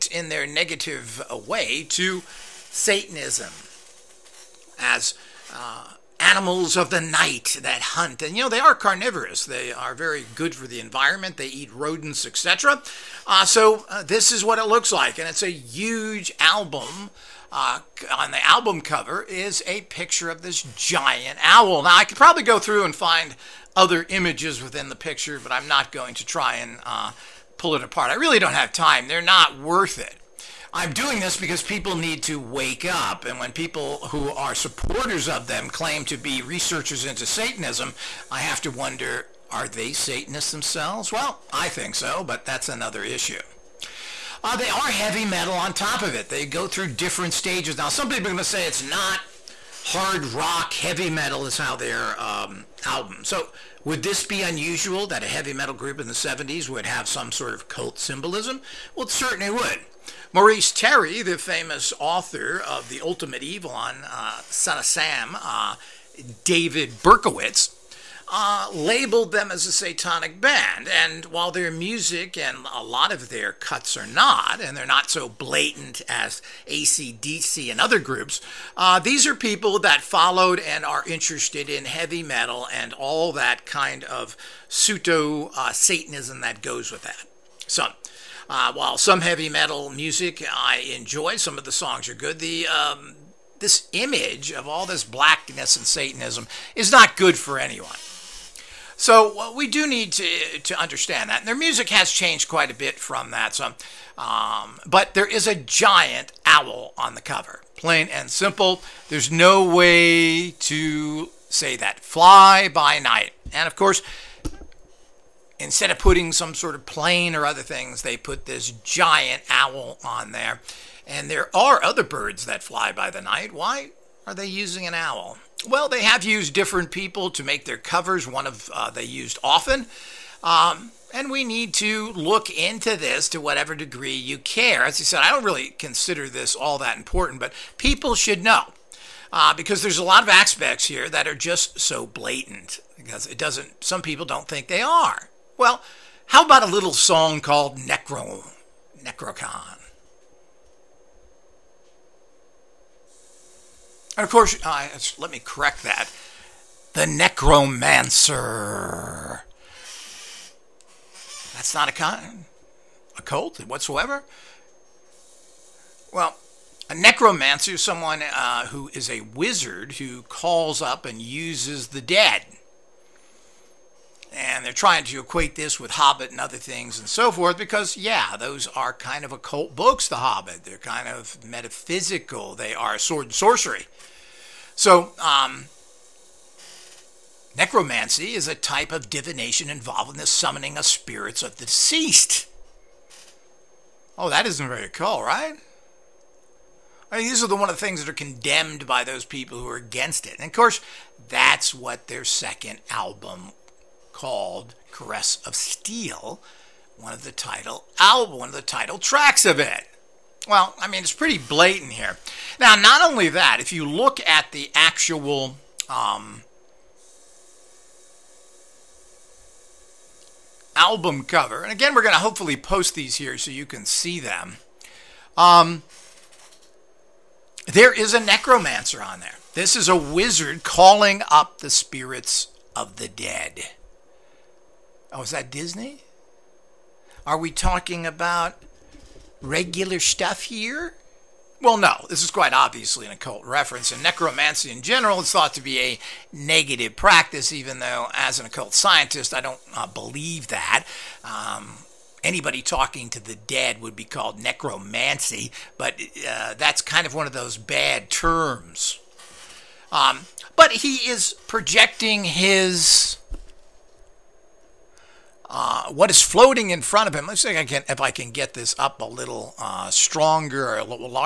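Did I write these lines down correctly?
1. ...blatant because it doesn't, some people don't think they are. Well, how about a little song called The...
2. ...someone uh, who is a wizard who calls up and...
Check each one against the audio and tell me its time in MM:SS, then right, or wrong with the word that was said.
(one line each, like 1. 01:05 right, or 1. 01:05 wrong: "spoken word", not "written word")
1. 02:22 wrong: "Necro", not "The"
2. 02:47 right.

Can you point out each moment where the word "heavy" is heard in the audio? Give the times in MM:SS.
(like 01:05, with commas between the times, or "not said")
00:44, 00:50, 00:55, 01:21, 01:29.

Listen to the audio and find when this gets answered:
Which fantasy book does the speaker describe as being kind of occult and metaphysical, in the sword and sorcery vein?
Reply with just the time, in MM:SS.
03:00.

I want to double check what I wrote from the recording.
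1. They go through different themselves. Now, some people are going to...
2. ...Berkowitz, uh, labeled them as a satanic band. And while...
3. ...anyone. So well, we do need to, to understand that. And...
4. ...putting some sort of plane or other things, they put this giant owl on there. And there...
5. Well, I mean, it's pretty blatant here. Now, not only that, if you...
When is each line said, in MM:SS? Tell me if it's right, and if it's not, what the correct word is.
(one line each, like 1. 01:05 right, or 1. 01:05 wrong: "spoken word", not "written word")
1. 00:46 wrong: "stages", not "themselves"
2. 01:07 right
3. 01:37 right
4. 01:55 right
5. 03:30 right.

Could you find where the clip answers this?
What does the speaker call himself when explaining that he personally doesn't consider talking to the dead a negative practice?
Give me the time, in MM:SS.
04:08.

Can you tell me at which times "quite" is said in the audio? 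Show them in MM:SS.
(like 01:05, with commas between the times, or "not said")
01:42, 04:02.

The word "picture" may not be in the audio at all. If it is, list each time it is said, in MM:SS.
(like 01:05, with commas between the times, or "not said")
00:19, 00:24.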